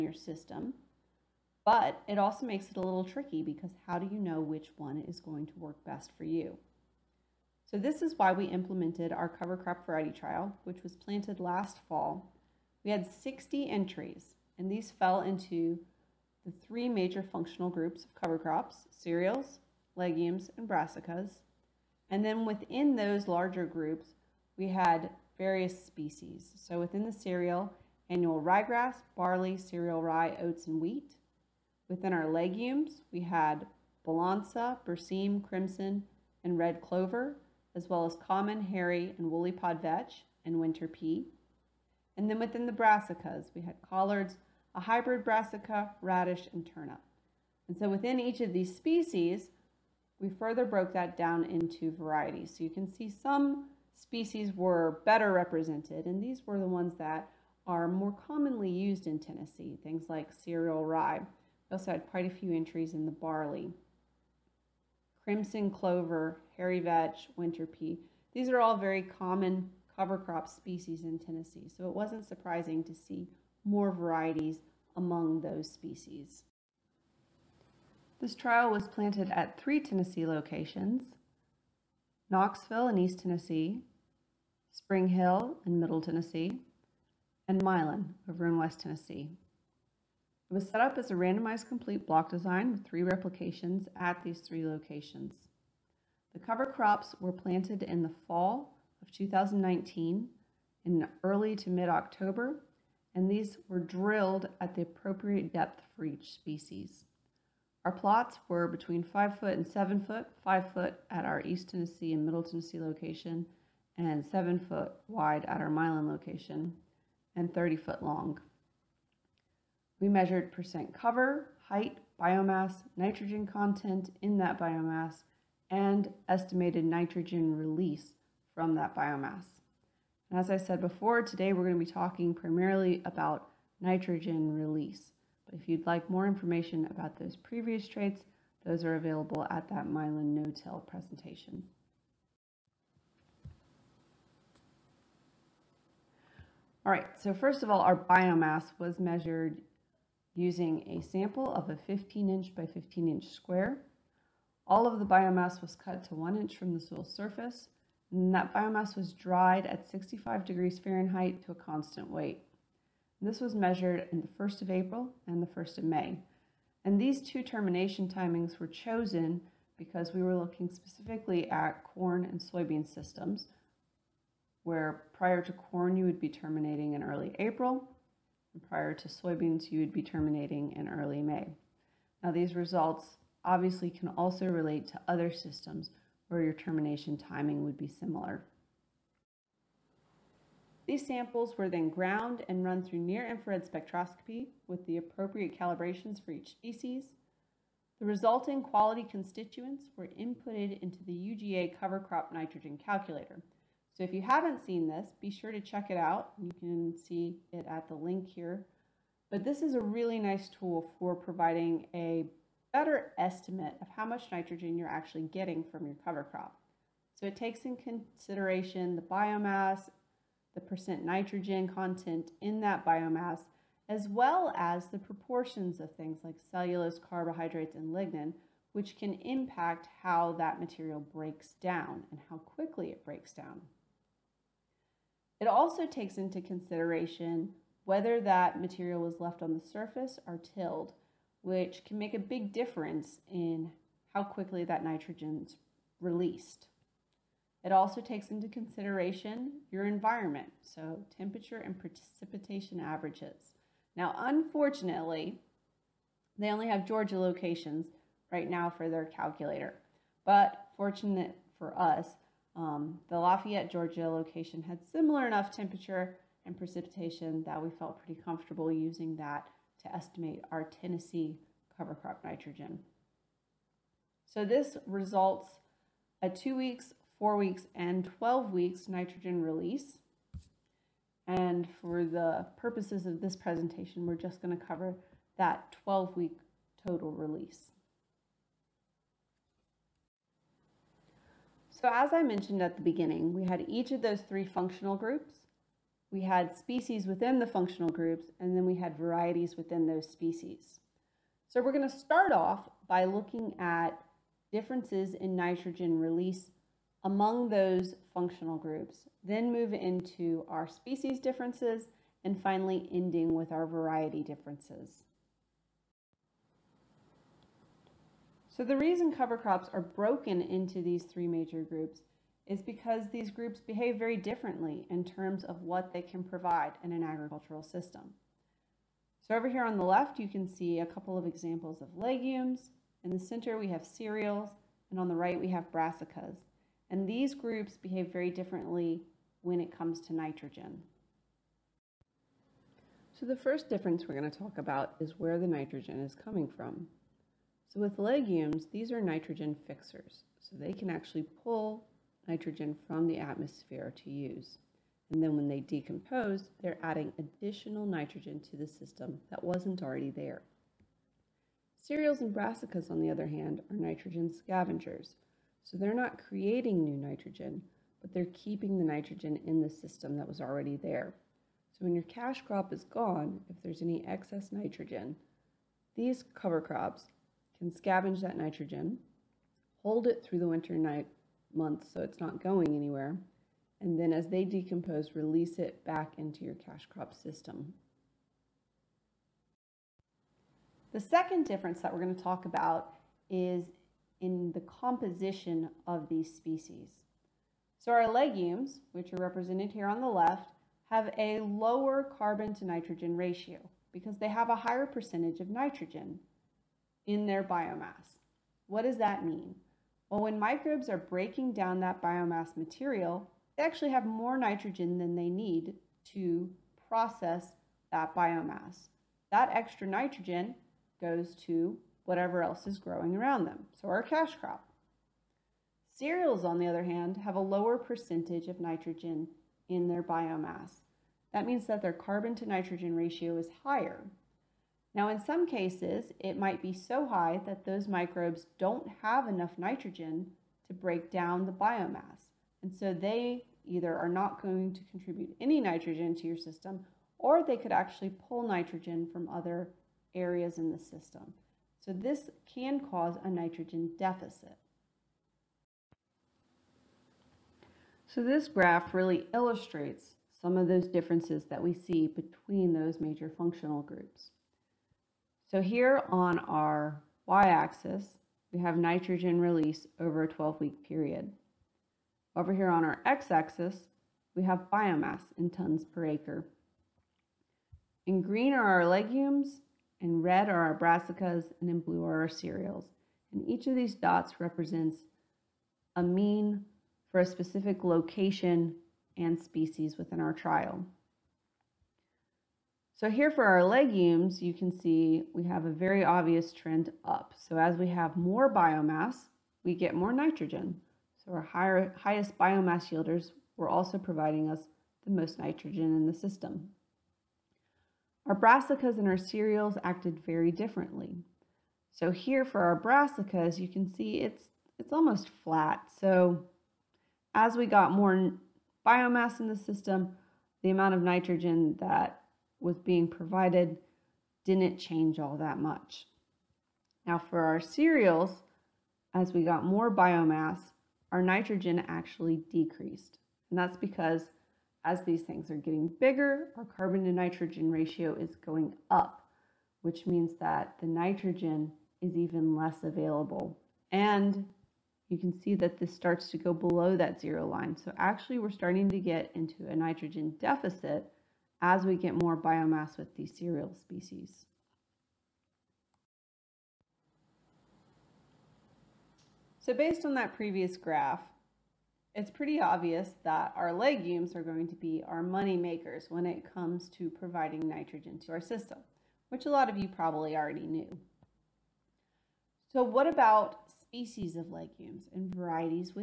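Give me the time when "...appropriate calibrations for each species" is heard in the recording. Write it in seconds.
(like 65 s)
194 s.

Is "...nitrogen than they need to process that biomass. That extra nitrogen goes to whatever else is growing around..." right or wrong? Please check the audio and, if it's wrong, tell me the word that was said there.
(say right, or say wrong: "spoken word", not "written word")
right.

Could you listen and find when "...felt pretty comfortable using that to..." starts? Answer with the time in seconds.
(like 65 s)
267 s.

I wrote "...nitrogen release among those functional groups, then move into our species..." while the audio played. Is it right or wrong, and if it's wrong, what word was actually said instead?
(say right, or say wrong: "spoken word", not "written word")
right.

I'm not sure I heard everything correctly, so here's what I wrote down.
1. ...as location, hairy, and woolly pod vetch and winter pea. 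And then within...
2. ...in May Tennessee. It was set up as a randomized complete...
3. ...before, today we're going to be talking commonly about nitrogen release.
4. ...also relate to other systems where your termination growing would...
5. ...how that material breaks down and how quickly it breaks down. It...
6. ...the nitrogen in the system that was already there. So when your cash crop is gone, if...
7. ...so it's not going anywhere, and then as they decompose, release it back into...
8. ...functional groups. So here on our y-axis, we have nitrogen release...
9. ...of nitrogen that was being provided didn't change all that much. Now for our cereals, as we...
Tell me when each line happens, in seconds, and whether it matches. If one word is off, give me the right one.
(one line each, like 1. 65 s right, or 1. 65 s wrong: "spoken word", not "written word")
1. 38 s wrong: "common", not "location"
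2. 88 s wrong: "West", not "May"
3. 130 s wrong: "primarily", not "commonly"
4. 184 s wrong: "timing", not "growing"
5. 230 s right
6. 368 s right
7. 381 s right
8. 463 s right
9. 520 s right.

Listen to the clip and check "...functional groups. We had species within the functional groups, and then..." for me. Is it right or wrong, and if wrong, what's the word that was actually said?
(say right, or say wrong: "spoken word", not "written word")
right.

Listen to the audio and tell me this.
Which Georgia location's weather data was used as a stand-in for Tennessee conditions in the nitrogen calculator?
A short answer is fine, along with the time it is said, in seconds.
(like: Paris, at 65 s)
Lafayette, Georgia, at 263 s.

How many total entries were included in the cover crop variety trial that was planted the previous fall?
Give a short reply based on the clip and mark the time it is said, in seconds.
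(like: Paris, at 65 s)
60, at 13 s.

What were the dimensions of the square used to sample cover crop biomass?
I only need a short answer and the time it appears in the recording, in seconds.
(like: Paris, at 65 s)
15 inch by 15 inch, at 151 s.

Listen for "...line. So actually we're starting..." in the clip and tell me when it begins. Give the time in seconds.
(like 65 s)
547 s.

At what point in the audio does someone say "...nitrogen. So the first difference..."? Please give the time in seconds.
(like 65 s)
340 s.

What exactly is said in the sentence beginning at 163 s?
This was measured in the 1st of April and the 1st of May.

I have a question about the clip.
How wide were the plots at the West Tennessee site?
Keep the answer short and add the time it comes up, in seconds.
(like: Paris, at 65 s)
7 feet, at 114 s.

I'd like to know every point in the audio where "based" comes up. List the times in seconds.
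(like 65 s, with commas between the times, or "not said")
559 s.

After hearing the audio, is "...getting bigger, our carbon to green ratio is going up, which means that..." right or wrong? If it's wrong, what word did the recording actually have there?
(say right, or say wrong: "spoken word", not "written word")
wrong: "nitrogen", not "green".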